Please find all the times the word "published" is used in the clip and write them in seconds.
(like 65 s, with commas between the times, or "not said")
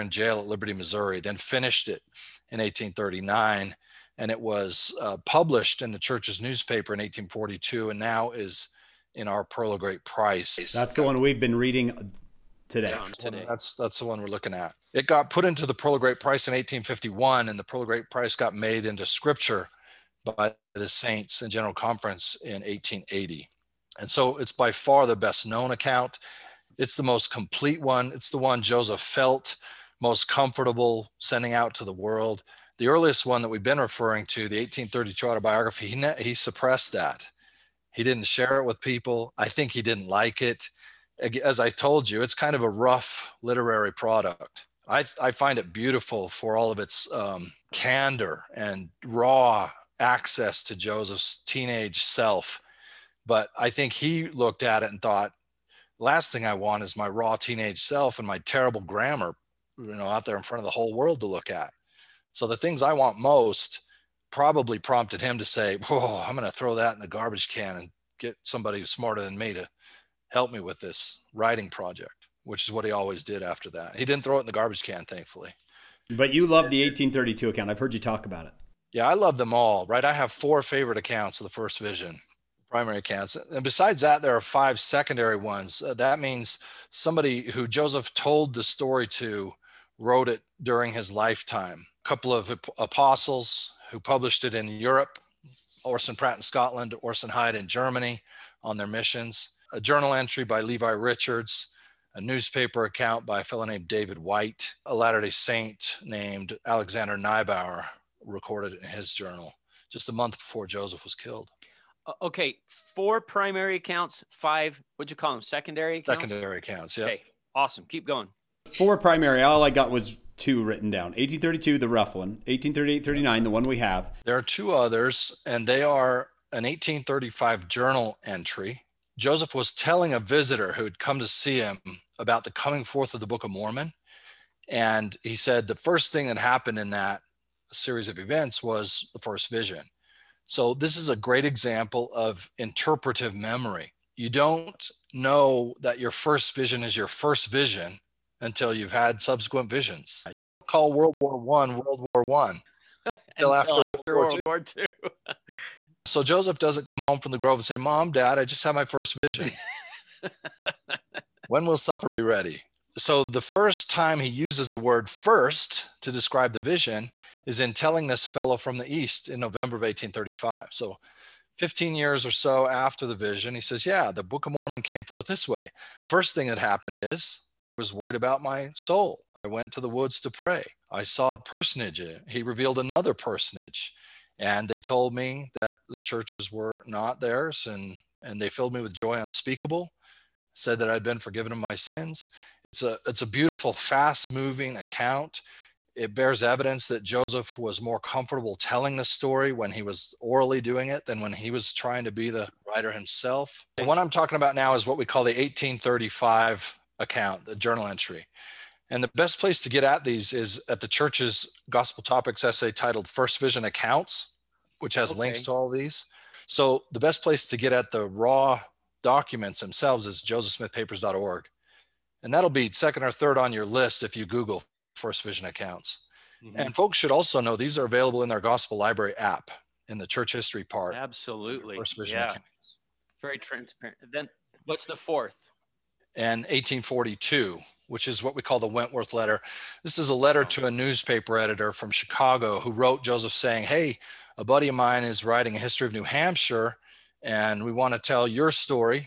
5 s, 93 s.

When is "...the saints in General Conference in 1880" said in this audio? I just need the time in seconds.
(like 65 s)
20 s.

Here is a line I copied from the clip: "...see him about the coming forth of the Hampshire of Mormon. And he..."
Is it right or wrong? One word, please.
wrong.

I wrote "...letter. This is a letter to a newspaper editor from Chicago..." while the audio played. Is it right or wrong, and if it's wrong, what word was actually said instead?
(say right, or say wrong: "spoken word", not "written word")
right.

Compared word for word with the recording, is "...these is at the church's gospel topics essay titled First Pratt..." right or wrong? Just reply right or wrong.
wrong.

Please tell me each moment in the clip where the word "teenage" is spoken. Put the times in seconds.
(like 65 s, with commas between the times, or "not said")
51 s, 57 s.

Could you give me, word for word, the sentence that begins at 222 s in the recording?
And that'll be second or third on your list if you Google First Vision Accounts.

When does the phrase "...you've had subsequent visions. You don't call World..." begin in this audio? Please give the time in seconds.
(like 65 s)
148 s.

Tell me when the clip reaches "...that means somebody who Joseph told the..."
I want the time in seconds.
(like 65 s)
85 s.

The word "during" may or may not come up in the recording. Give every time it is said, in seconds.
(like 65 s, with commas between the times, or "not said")
90 s.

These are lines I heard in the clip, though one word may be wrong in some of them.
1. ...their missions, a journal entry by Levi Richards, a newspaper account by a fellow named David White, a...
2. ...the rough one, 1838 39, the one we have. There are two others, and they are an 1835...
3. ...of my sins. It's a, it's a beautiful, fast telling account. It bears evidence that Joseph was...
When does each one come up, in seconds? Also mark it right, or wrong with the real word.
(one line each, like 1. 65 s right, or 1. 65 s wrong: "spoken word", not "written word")
1. 98 s right
2. 121 s right
3. 191 s wrong: "moving", not "telling".